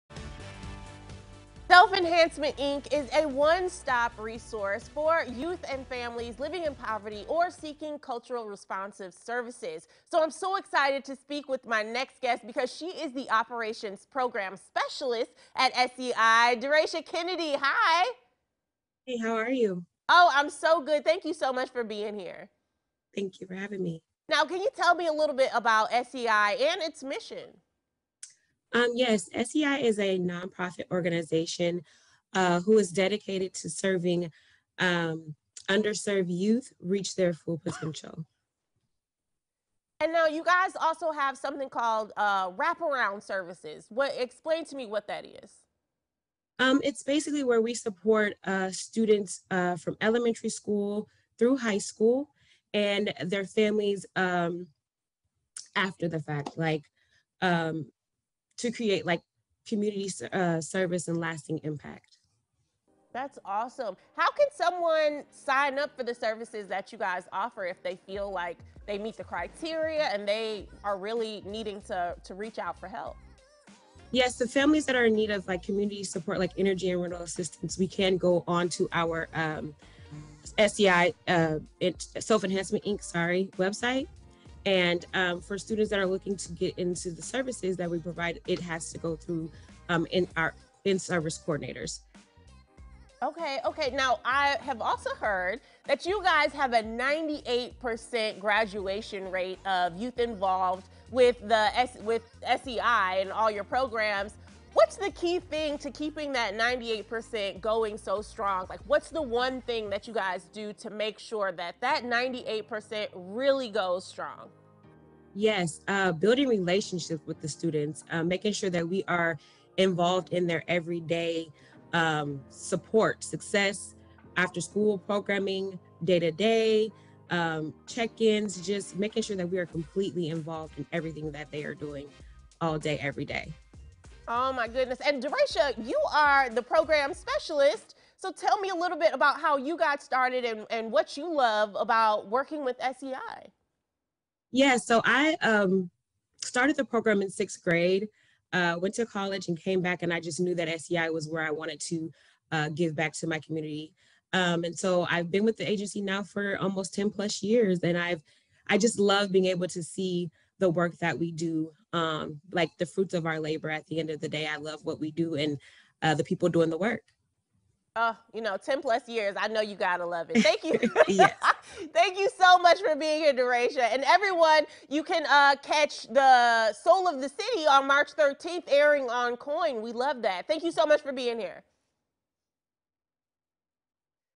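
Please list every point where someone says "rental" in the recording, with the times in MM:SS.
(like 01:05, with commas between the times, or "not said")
01:17.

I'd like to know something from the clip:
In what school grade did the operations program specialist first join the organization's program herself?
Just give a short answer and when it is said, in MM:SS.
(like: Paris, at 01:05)
sixth grade, at 02:27.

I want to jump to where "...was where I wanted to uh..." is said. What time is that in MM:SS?
02:31.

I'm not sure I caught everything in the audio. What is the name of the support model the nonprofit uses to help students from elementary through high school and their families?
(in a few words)
wraparound services.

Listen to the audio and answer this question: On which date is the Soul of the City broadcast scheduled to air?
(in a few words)
March 13.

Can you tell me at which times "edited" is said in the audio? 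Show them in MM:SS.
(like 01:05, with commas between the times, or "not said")
not said.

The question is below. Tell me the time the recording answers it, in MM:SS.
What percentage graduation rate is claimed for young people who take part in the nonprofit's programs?
01:36.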